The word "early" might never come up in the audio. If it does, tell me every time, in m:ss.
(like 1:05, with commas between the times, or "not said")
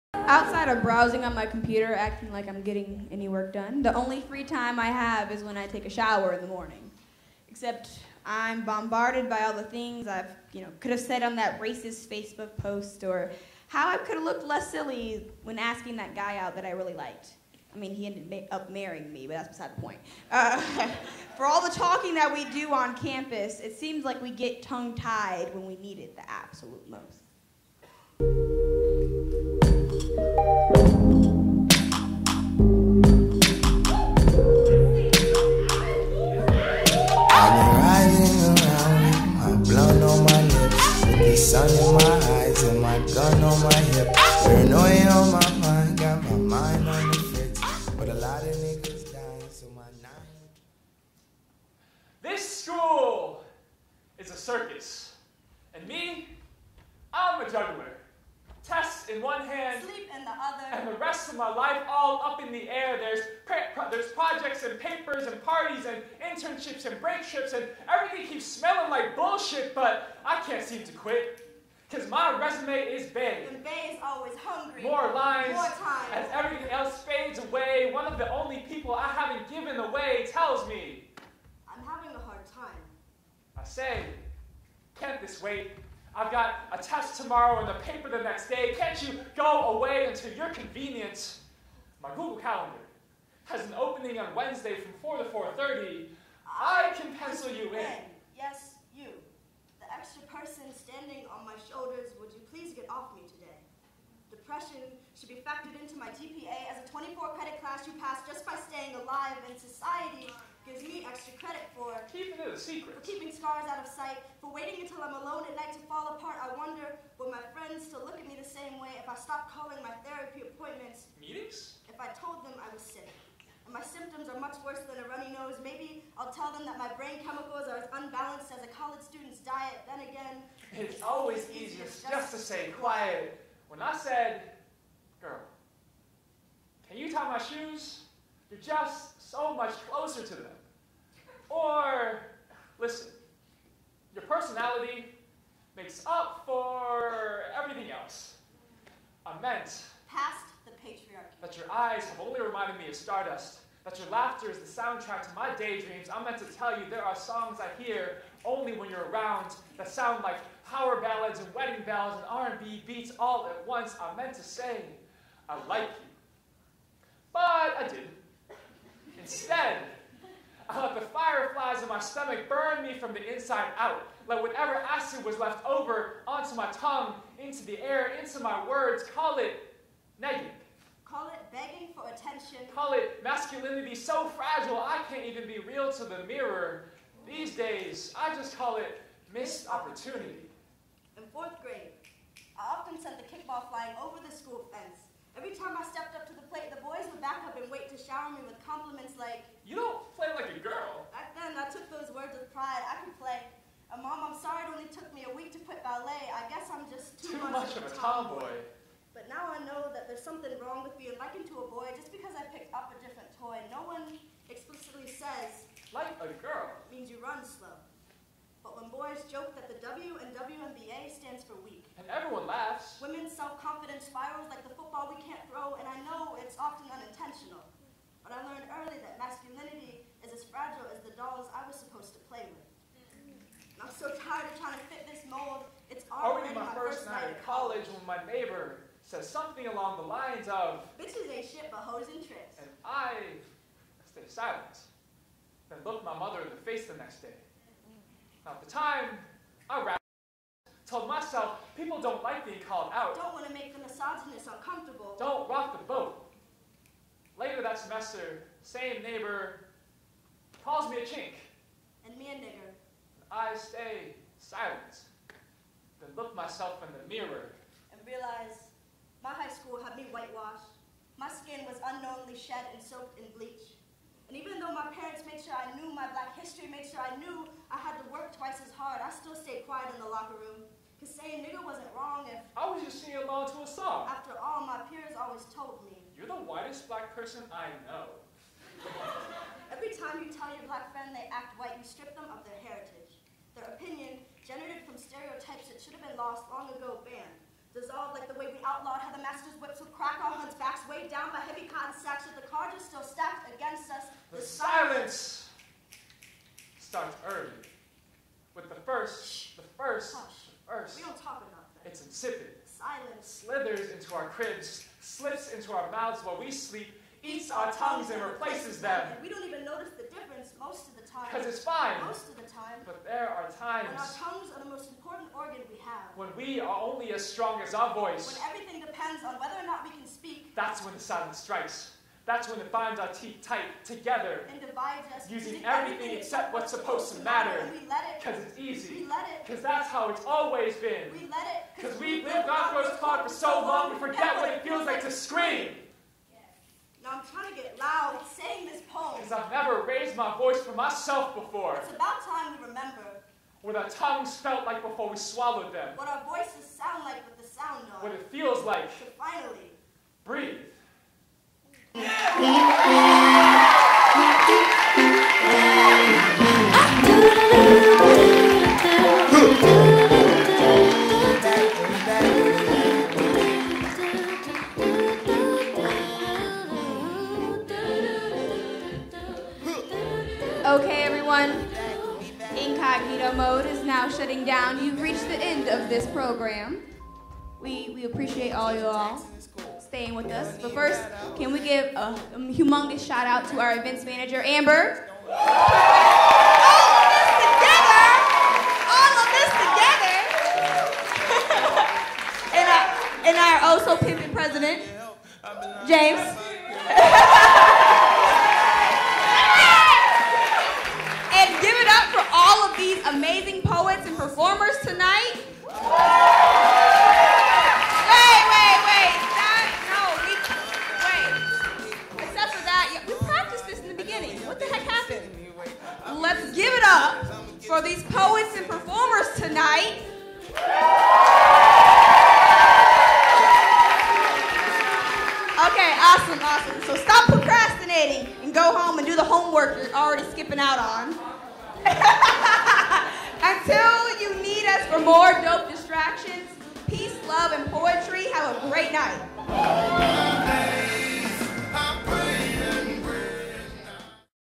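3:48, 5:07.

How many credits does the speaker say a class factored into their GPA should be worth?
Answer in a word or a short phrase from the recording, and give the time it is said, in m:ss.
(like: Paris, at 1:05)
24, at 1:46.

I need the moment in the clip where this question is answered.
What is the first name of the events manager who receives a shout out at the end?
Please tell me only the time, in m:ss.
6:34.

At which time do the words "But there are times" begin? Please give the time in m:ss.
5:22.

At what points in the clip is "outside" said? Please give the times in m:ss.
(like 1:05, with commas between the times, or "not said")
0:00.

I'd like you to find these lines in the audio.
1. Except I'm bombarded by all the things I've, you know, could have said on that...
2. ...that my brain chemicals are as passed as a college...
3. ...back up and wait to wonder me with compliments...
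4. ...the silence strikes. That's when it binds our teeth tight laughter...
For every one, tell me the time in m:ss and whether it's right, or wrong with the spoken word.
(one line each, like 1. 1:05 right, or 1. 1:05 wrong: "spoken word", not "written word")
1. 0:07 right
2. 2:06 wrong: "unbalanced", not "passed"
3. 3:17 wrong: "shower", not "wonder"
4. 5:30 wrong: "together", not "laughter".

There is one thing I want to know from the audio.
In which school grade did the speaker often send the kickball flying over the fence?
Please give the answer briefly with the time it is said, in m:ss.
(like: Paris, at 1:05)
Fourth grade, at 3:11.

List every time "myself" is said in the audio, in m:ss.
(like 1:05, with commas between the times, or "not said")
4:11, 4:26, 5:50.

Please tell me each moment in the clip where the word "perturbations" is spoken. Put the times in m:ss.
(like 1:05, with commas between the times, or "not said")
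not said.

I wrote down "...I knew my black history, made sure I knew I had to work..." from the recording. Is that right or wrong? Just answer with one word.
right.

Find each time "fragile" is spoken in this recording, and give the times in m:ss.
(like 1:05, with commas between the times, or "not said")
3:04, 3:50.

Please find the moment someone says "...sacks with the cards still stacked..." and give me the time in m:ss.
5:02.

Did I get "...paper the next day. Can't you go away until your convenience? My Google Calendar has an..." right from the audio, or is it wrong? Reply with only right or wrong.
right.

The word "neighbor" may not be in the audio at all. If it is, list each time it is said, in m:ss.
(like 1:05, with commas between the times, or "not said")
3:58, 4:19.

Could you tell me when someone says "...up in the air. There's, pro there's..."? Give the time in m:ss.
1:02.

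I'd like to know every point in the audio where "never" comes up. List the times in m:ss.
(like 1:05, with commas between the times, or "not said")
5:49.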